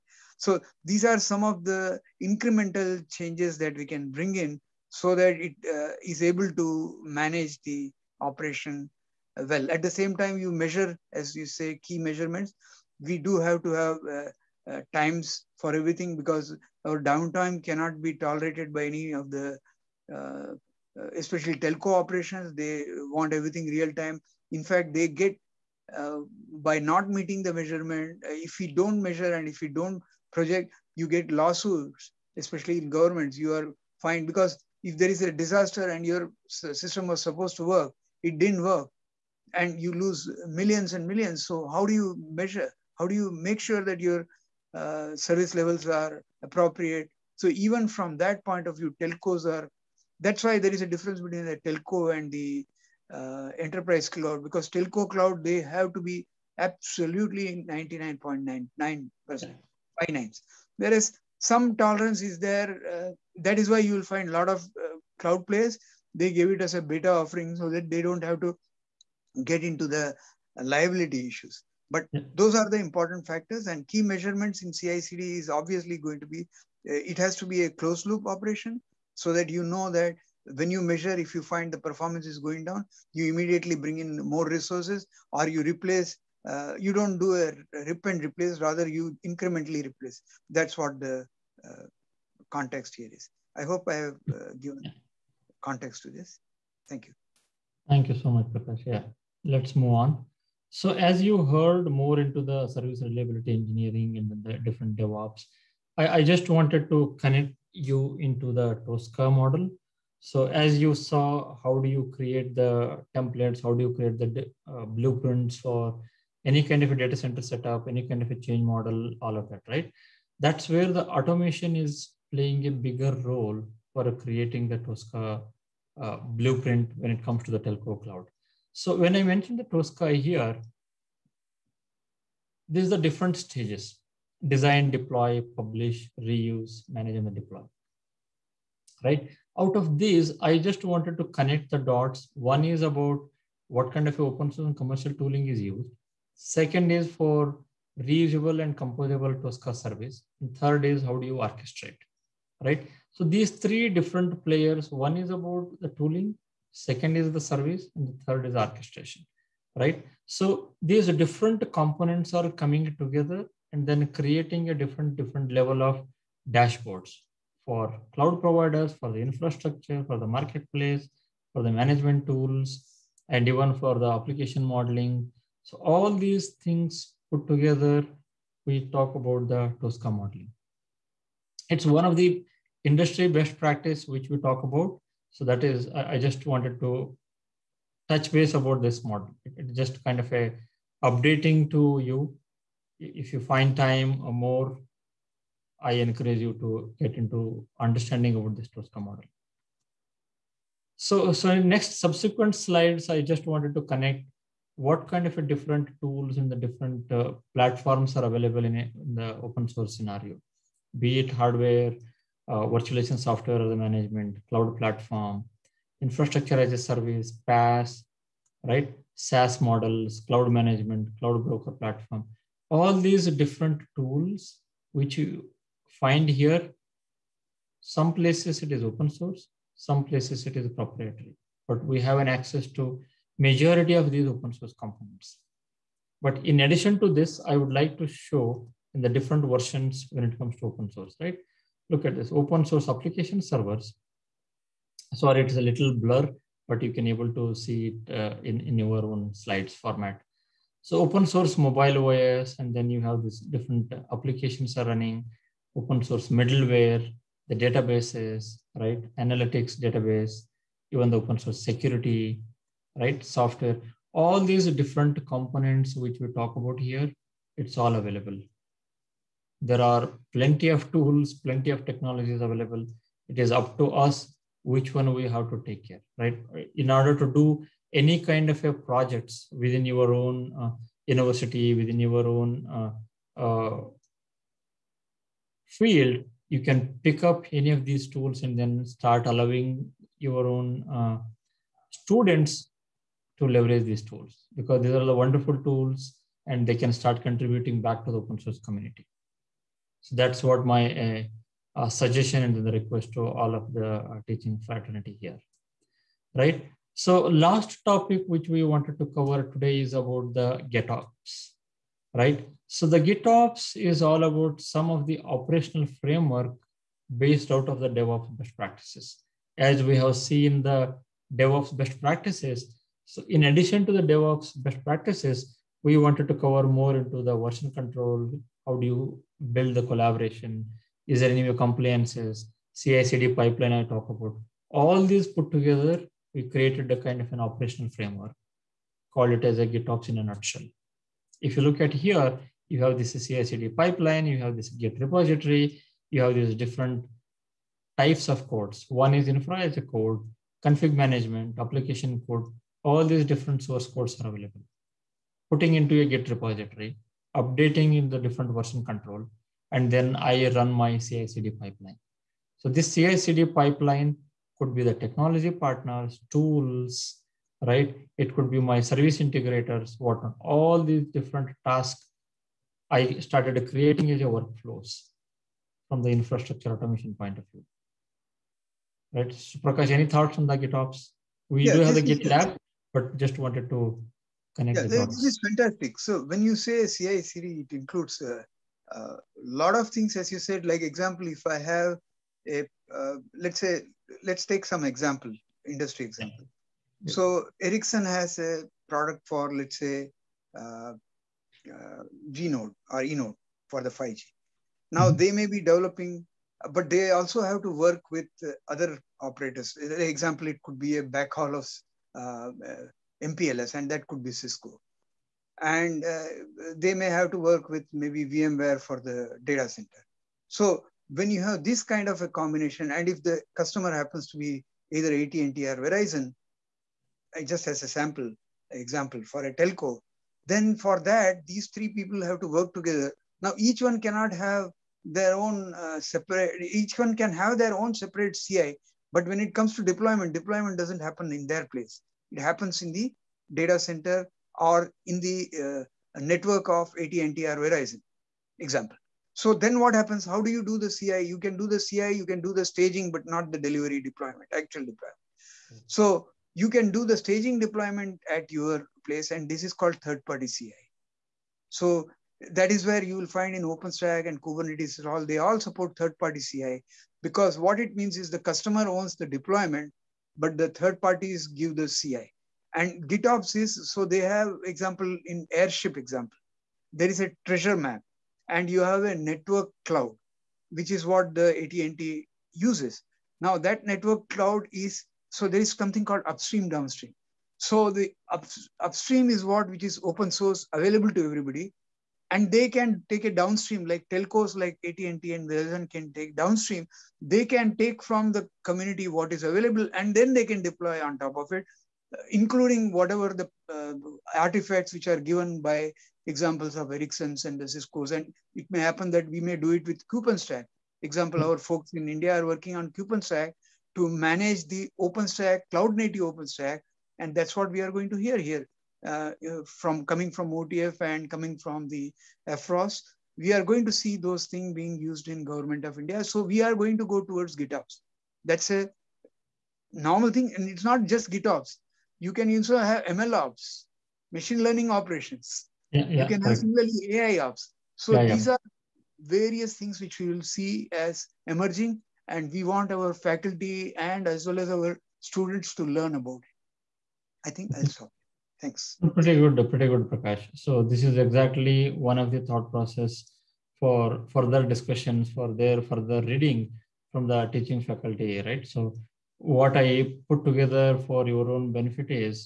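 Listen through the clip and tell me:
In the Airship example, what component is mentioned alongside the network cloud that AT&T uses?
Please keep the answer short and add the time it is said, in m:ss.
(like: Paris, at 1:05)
Treasure map, at 7:57.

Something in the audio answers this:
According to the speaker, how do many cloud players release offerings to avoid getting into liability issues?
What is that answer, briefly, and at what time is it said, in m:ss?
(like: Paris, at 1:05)
As a beta offering, at 1:06.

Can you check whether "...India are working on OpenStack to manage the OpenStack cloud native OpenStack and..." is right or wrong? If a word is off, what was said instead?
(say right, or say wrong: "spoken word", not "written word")
right.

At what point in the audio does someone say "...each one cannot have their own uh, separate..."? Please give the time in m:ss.
7:13.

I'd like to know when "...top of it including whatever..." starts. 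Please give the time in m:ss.
8:21.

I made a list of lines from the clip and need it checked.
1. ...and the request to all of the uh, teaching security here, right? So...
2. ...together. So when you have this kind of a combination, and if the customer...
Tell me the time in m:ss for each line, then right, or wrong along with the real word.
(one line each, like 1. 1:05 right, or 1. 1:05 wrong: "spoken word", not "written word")
1. 5:02 wrong: "fraternity", not "security"
2. 6:59 wrong: "center", not "together".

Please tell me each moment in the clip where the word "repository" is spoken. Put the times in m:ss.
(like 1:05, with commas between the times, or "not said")
5:44, 5:56.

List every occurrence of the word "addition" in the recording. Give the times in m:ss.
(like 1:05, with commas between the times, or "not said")
3:56, 5:23.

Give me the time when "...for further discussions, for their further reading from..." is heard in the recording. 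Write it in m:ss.
9:13.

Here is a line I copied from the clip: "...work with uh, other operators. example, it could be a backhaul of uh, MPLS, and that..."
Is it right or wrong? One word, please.
right.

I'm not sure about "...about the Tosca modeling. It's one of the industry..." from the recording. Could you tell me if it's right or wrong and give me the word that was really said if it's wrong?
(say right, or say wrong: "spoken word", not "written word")
right.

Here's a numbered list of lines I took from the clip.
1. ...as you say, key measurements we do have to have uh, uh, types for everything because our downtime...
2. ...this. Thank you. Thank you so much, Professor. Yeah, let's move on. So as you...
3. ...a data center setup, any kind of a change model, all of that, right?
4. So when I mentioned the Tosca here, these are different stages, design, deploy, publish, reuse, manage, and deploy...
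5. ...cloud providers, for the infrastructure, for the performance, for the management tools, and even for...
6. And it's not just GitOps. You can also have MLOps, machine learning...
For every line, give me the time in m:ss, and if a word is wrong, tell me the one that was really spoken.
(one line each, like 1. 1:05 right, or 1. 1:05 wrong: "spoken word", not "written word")
1. 0:11 wrong: "times", not "types"
2. 1:36 right
3. 1:56 right
4. 2:08 right
5. 2:48 wrong: "marketplace", not "performance"
6. 8:50 right.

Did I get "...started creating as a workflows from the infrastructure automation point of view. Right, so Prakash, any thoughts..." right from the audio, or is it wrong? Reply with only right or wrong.
right.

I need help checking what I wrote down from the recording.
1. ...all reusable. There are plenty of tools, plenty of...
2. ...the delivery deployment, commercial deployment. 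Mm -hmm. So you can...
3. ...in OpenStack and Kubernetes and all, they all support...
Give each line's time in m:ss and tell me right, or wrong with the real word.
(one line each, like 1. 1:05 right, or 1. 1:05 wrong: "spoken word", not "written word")
1. 4:27 wrong: "available", not "reusable"
2. 7:33 wrong: "actual", not "commercial"
3. 7:43 right.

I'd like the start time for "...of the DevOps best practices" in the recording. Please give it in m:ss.
5:17.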